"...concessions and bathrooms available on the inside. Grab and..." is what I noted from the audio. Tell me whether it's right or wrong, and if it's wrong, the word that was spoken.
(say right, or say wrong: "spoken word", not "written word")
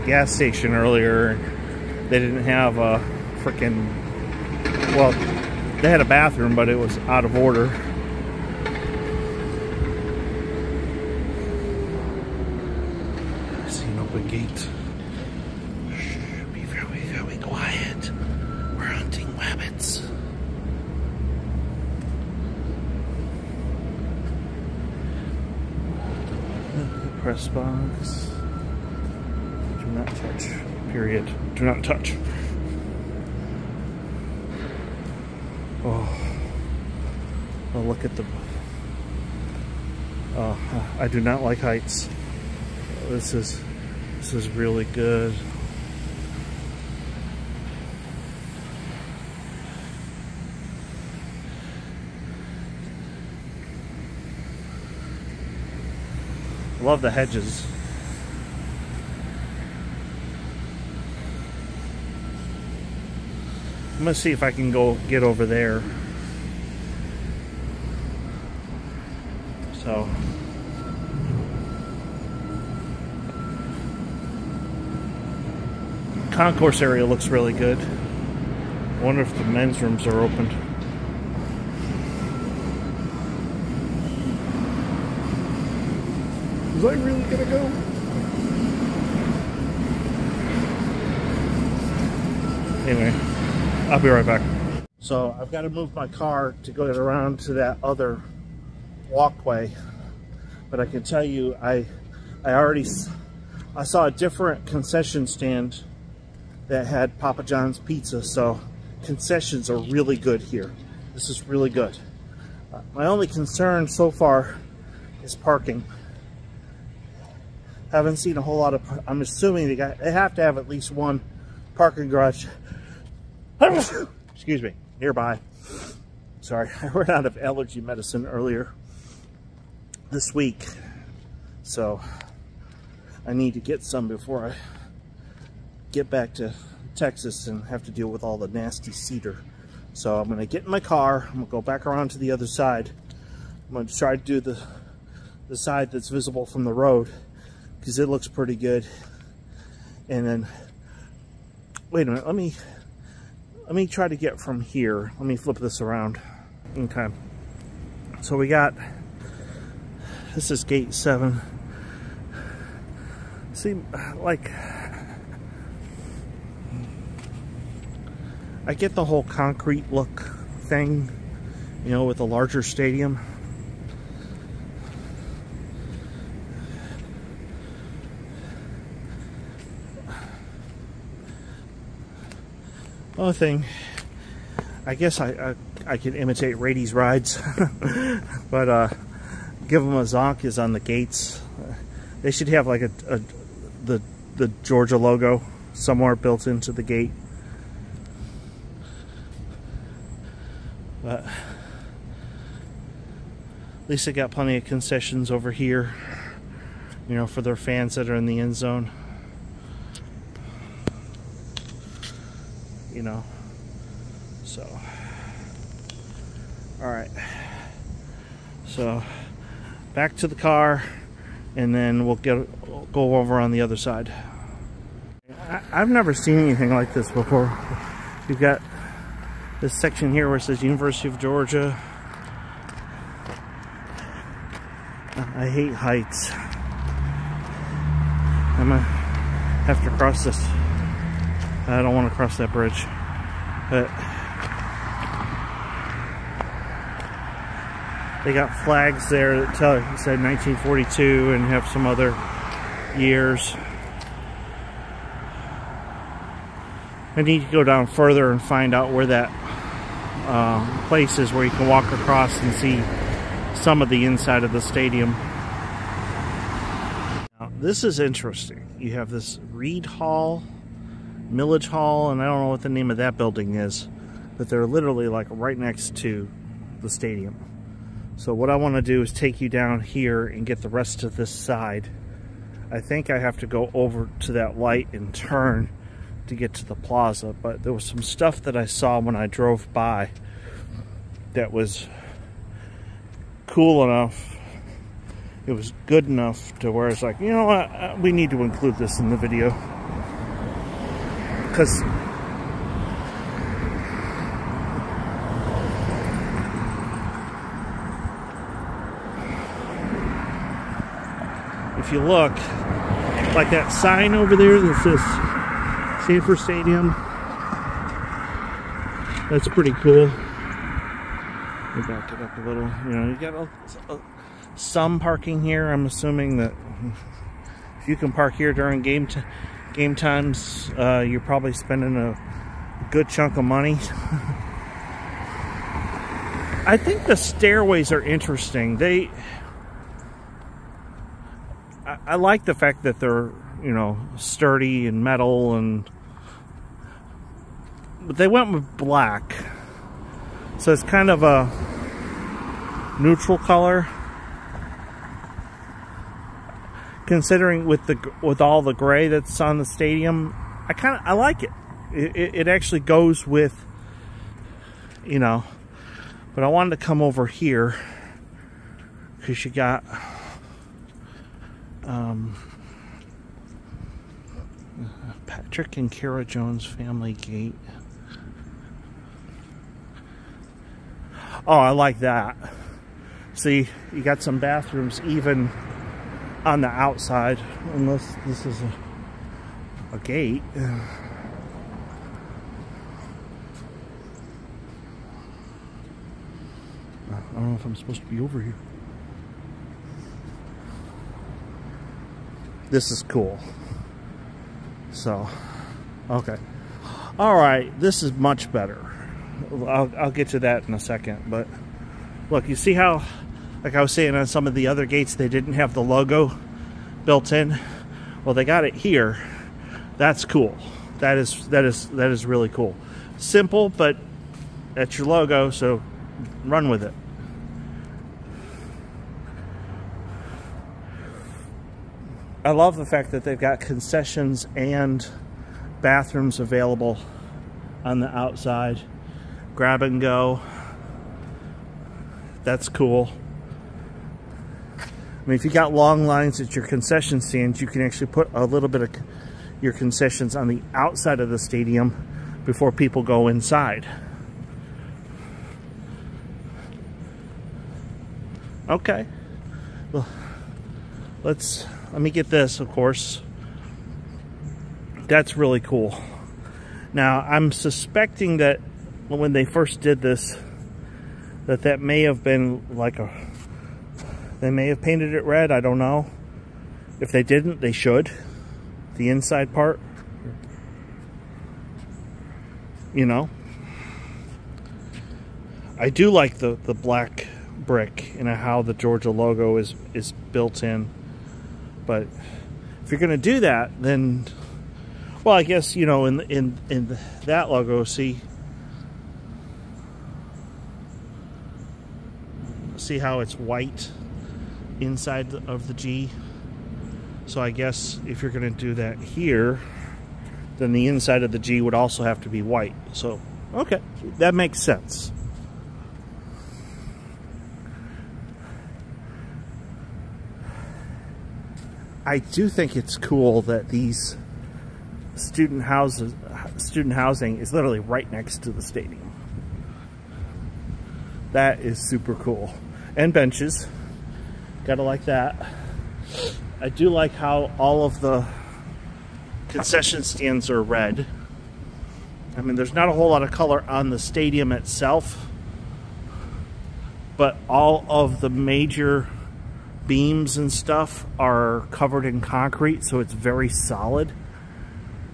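wrong: "outside", not "inside".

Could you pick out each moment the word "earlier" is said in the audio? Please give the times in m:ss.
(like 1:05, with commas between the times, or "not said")
0:00, 2:08.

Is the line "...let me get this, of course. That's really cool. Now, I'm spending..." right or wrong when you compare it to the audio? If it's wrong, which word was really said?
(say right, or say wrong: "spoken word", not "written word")
wrong: "suspecting", not "spending".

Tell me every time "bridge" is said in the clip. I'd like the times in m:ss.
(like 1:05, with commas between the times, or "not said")
4:02.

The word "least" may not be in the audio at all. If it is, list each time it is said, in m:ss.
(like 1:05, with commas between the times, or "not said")
2:00, 3:23.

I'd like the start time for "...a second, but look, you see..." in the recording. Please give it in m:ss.
6:50.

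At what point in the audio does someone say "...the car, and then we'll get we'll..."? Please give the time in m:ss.
3:40.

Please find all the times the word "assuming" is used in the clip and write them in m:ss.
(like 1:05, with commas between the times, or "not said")
1:59, 5:25.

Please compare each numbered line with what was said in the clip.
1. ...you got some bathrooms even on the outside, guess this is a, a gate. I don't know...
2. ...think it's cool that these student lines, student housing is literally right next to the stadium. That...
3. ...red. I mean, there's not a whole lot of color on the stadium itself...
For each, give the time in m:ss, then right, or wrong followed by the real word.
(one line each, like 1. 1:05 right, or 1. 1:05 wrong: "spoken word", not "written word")
1. 6:23 wrong: "unless", not "guess"
2. 8:42 wrong: "houses", not "lines"
3. 9:00 right.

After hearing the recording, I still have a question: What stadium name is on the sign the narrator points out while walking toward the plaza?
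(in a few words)
Sanford Stadium.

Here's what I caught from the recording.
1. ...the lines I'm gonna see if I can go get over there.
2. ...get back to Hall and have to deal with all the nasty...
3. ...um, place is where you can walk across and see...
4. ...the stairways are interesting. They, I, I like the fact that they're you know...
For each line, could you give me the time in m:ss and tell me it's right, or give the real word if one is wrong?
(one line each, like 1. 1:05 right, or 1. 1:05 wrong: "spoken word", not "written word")
1. 0:57 wrong: "hedges", not "lines"
2. 2:15 wrong: "Texas", not "Hall"
3. 4:20 right
4. 5:37 right.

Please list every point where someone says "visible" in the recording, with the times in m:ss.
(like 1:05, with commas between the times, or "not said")
2:26.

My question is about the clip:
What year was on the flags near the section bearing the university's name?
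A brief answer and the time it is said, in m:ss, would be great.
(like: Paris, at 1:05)
1942, at 4:10.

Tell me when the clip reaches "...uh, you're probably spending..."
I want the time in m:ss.
5:30.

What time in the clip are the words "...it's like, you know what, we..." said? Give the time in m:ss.
4:56.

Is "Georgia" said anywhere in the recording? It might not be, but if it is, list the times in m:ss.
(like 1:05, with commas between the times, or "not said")
3:14, 3:51, 8:08.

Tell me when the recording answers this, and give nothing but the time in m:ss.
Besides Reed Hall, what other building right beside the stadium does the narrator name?
4:31.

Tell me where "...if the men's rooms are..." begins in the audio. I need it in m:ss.
1:19.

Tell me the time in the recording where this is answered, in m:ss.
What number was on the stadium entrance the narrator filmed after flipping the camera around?
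2:40.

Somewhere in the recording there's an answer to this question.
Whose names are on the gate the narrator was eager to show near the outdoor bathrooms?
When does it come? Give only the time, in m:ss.
6:15.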